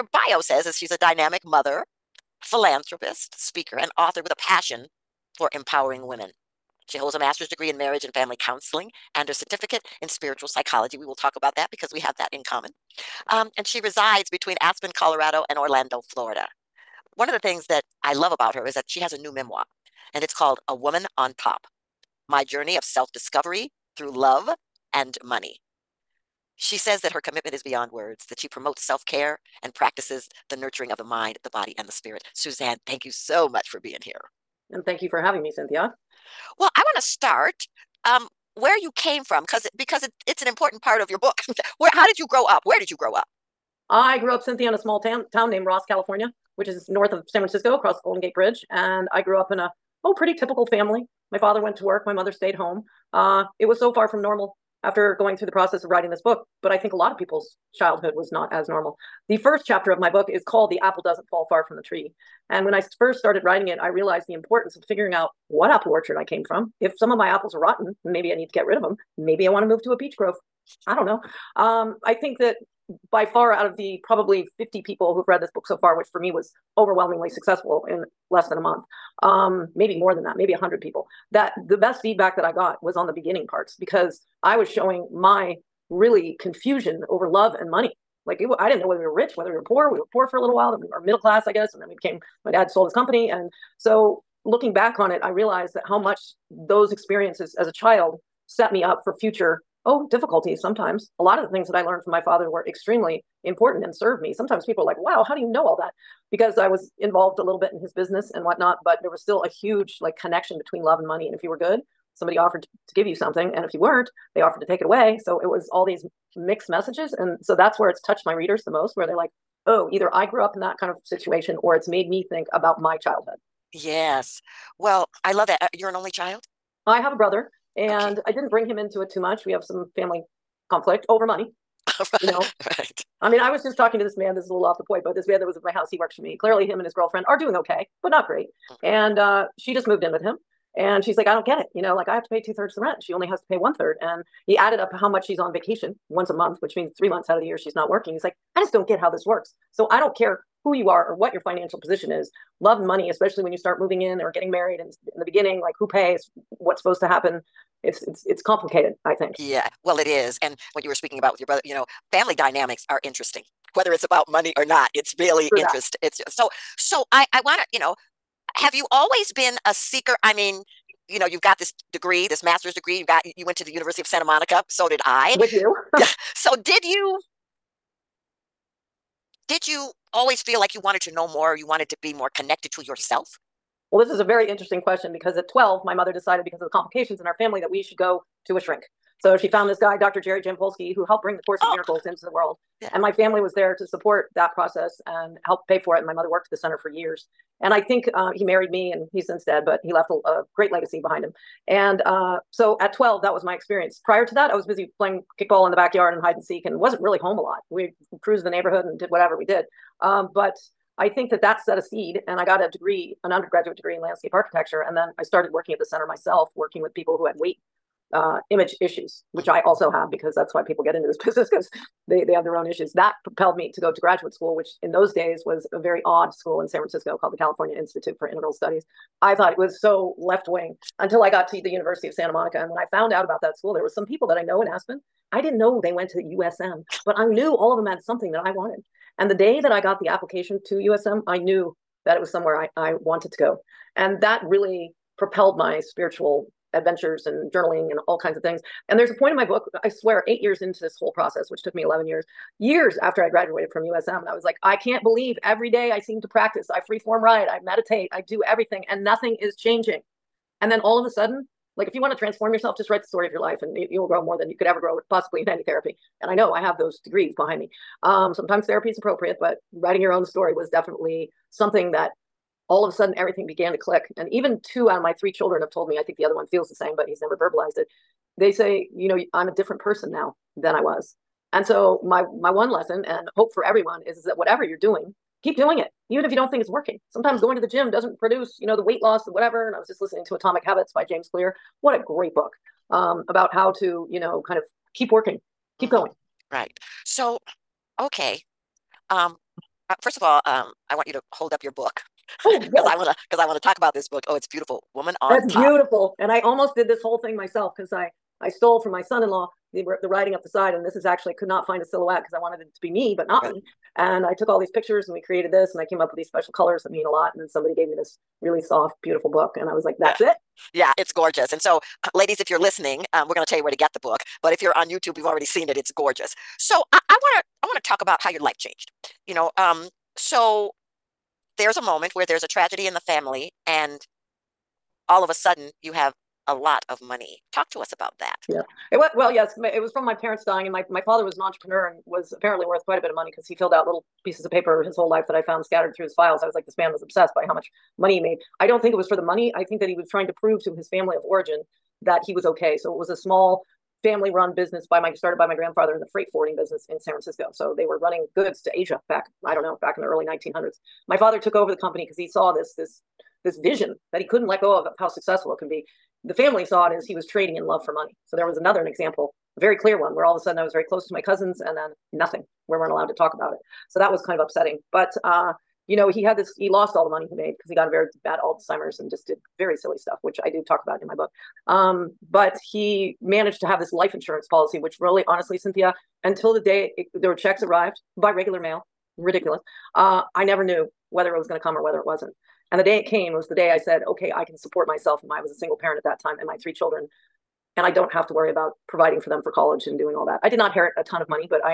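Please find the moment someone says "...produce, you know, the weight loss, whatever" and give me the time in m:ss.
4:48.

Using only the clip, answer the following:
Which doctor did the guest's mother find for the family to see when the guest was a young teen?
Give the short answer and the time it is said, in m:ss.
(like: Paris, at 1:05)
Jerry Jampolsky, at 3:09.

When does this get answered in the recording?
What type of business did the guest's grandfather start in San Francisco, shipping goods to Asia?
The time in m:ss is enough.
5:56.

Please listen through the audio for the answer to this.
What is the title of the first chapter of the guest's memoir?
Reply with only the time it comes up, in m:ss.
1:00.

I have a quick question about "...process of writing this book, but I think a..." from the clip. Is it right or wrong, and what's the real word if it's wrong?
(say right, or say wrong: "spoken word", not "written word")
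right.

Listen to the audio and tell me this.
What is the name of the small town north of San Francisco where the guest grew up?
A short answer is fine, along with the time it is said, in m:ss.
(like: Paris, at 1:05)
Ross, California, at 0:45.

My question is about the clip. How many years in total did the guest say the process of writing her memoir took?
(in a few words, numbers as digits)
11.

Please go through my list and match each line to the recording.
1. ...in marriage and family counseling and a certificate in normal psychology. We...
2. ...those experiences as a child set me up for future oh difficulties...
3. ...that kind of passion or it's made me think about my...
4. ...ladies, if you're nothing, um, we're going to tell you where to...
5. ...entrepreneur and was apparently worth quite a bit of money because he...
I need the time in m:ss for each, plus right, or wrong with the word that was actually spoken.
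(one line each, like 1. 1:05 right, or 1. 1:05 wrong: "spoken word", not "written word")
1. 0:07 wrong: "spiritual", not "normal"
2. 1:36 right
3. 2:00 wrong: "situation", not "passion"
4. 5:22 wrong: "listening", not "nothing"
5. 5:41 right.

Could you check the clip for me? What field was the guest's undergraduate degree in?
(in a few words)
Landscape architecture.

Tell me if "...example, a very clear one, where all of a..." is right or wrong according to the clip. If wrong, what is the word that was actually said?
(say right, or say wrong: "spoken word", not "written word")
right.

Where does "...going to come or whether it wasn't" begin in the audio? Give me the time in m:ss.
6:31.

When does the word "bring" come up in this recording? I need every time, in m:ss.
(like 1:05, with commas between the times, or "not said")
2:08, 3:11.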